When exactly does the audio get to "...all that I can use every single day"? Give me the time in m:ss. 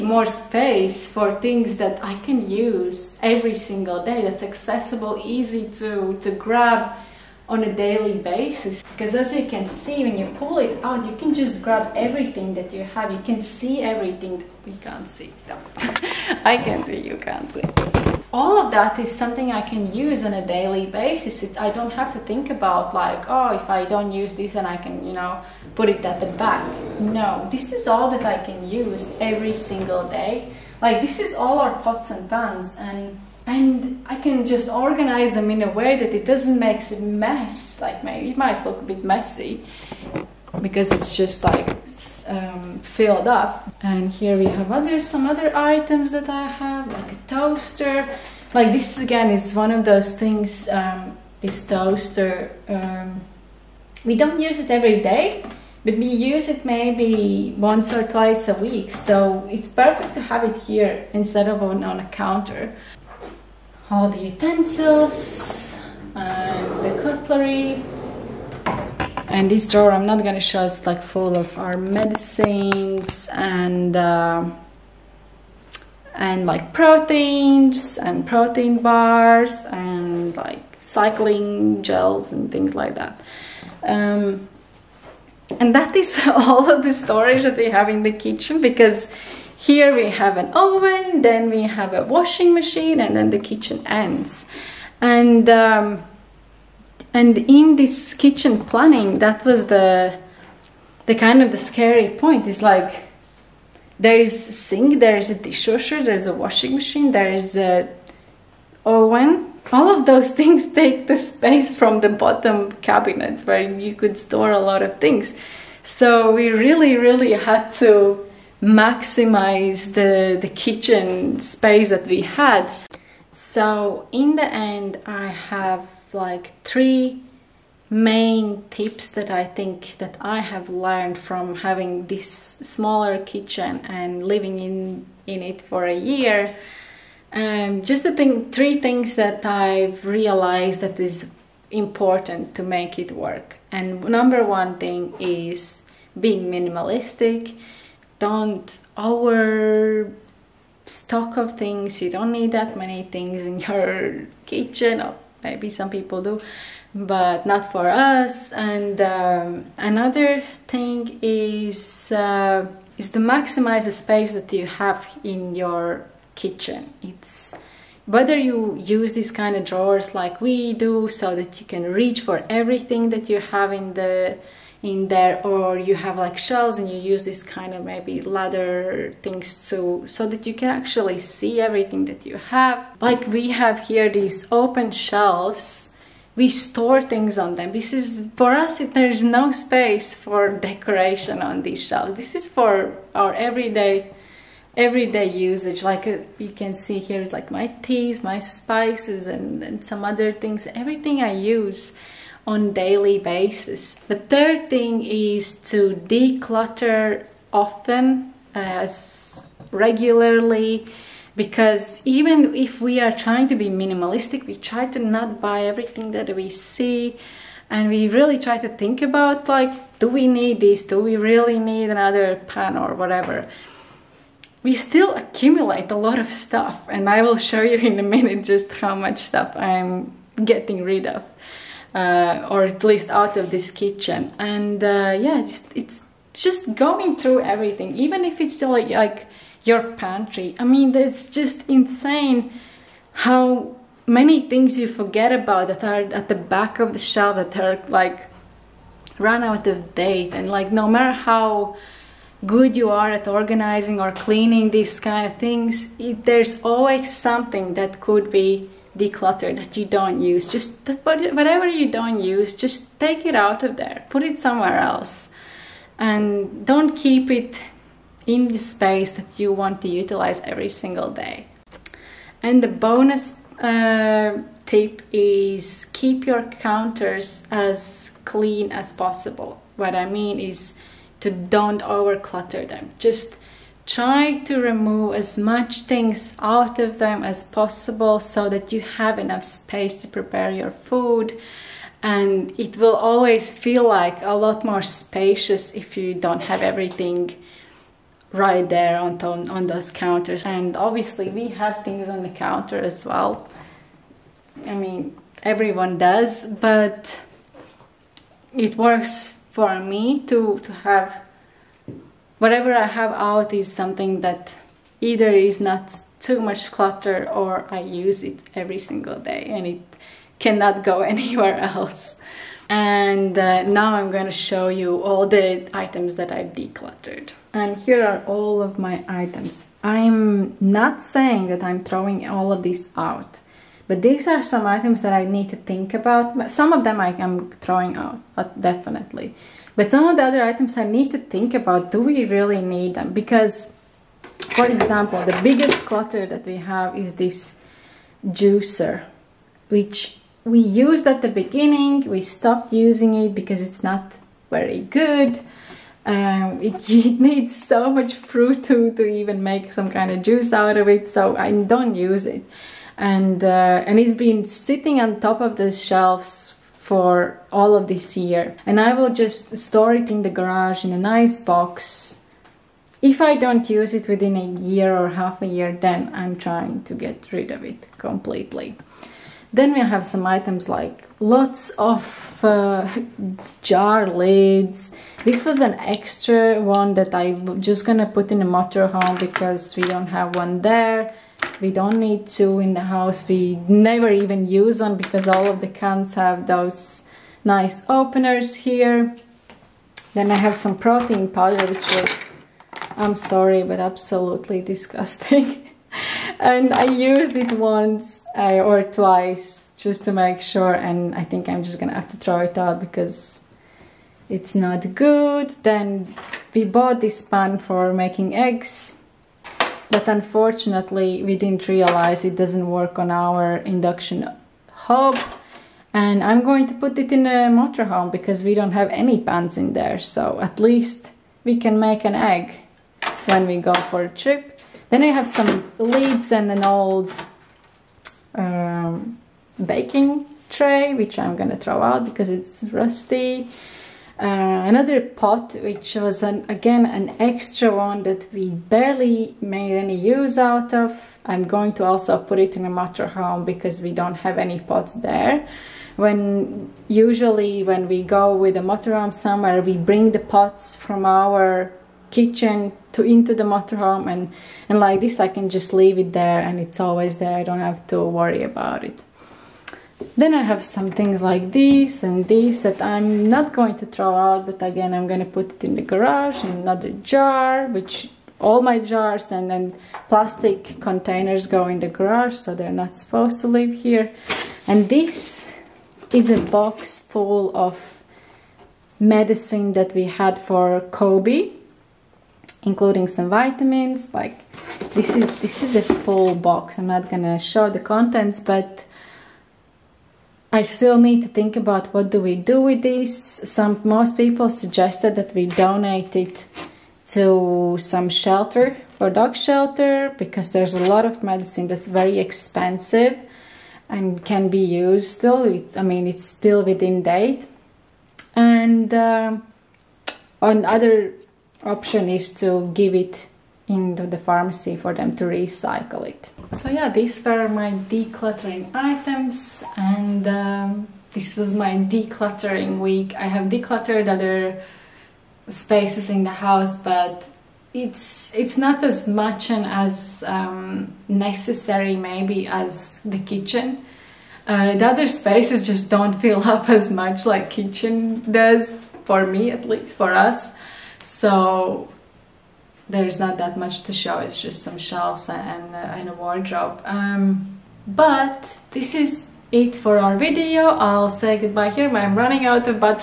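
0:27.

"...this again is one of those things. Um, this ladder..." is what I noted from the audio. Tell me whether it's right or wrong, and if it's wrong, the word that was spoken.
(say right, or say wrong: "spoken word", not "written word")
wrong: "toaster", not "ladder".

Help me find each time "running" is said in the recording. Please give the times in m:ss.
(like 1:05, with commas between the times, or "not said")
9:22.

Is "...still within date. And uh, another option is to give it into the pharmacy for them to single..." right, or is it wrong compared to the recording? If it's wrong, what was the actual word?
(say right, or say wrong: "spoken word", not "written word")
wrong: "recycle", not "single".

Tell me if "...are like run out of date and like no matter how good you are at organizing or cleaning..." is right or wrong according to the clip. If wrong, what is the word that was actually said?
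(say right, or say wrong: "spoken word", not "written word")
right.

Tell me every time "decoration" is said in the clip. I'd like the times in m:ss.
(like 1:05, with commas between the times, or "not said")
3:10.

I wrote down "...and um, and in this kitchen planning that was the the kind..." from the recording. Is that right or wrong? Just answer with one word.
right.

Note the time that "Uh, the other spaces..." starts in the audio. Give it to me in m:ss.
9:04.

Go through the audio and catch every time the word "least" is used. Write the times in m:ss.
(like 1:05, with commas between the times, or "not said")
3:52, 7:10, 9:09.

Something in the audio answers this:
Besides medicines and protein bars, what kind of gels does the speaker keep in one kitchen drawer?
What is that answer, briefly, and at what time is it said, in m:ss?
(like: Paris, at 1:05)
cycling gels, at 1:20.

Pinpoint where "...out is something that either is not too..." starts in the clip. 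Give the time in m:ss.
5:13.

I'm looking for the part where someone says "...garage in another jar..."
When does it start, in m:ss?
7:55.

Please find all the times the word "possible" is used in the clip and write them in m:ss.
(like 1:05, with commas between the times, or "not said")
4:38, 4:47.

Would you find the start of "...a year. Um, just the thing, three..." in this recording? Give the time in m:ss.
2:15.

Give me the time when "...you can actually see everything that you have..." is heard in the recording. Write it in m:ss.
3:00.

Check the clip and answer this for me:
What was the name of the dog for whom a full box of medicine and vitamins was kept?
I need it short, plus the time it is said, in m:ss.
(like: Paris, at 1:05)
Kobe, at 8:10.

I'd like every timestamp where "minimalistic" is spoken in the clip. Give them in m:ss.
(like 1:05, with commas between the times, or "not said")
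2:26, 3:33.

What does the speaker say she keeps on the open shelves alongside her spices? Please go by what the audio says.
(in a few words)
teas.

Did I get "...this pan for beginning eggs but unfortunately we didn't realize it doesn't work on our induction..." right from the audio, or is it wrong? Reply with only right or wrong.
wrong.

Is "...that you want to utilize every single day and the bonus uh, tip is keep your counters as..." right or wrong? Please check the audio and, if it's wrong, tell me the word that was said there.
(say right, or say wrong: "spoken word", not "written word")
right.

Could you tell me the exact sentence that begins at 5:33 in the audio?
But these are some items that I need to think about.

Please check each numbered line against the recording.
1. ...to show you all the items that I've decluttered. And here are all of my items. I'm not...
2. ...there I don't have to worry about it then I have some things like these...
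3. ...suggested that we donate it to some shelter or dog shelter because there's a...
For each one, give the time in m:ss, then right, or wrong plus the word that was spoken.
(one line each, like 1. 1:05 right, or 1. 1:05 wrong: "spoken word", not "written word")
1. 5:24 right
2. 7:47 right
3. 8:24 right.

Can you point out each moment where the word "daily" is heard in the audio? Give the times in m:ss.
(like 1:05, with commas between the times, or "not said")
0:07, 0:20, 3:22.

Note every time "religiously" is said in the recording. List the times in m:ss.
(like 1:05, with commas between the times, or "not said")
not said.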